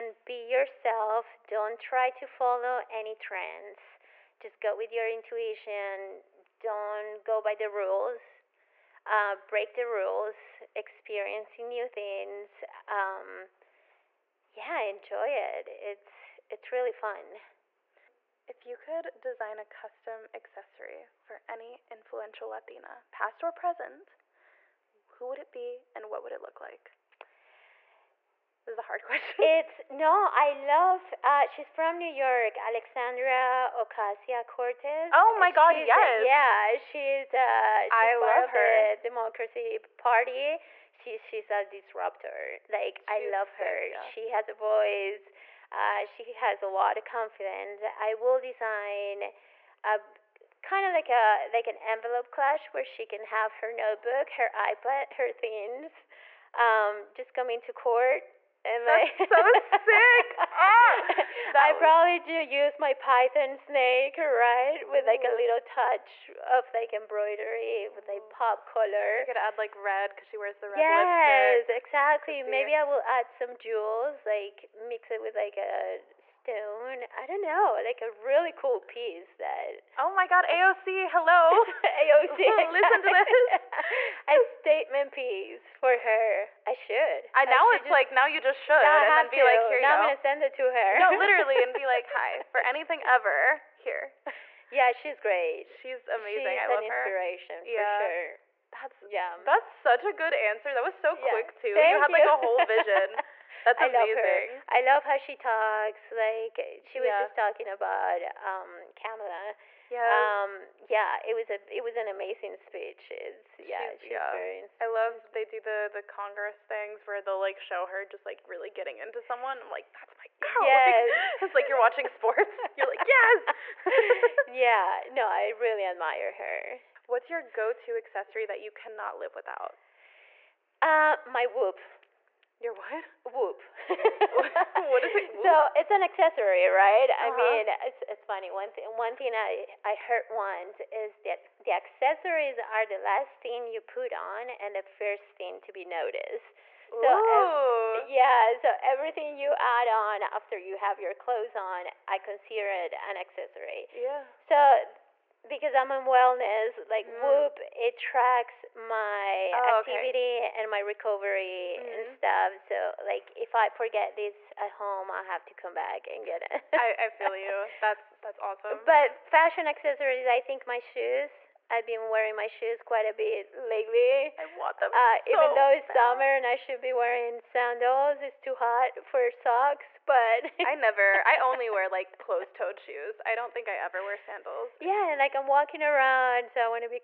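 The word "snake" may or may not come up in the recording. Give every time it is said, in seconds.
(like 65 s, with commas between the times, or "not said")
63 s.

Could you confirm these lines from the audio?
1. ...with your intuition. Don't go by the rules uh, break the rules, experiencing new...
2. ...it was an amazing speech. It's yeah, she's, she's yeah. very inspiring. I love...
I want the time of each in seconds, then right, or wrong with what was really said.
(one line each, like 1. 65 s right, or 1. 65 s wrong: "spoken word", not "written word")
1. 4 s right
2. 111 s right.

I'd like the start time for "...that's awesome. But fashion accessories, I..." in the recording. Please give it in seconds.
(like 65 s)
168 s.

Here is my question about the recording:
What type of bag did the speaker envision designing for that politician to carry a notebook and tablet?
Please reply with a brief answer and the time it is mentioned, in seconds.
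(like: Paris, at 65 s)
Envelope clutch, at 51 s.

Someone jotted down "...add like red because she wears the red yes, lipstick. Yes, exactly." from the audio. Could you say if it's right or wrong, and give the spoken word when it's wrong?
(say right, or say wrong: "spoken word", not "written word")
right.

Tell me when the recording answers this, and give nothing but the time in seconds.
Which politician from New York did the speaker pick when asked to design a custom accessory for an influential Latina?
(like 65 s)
32 s.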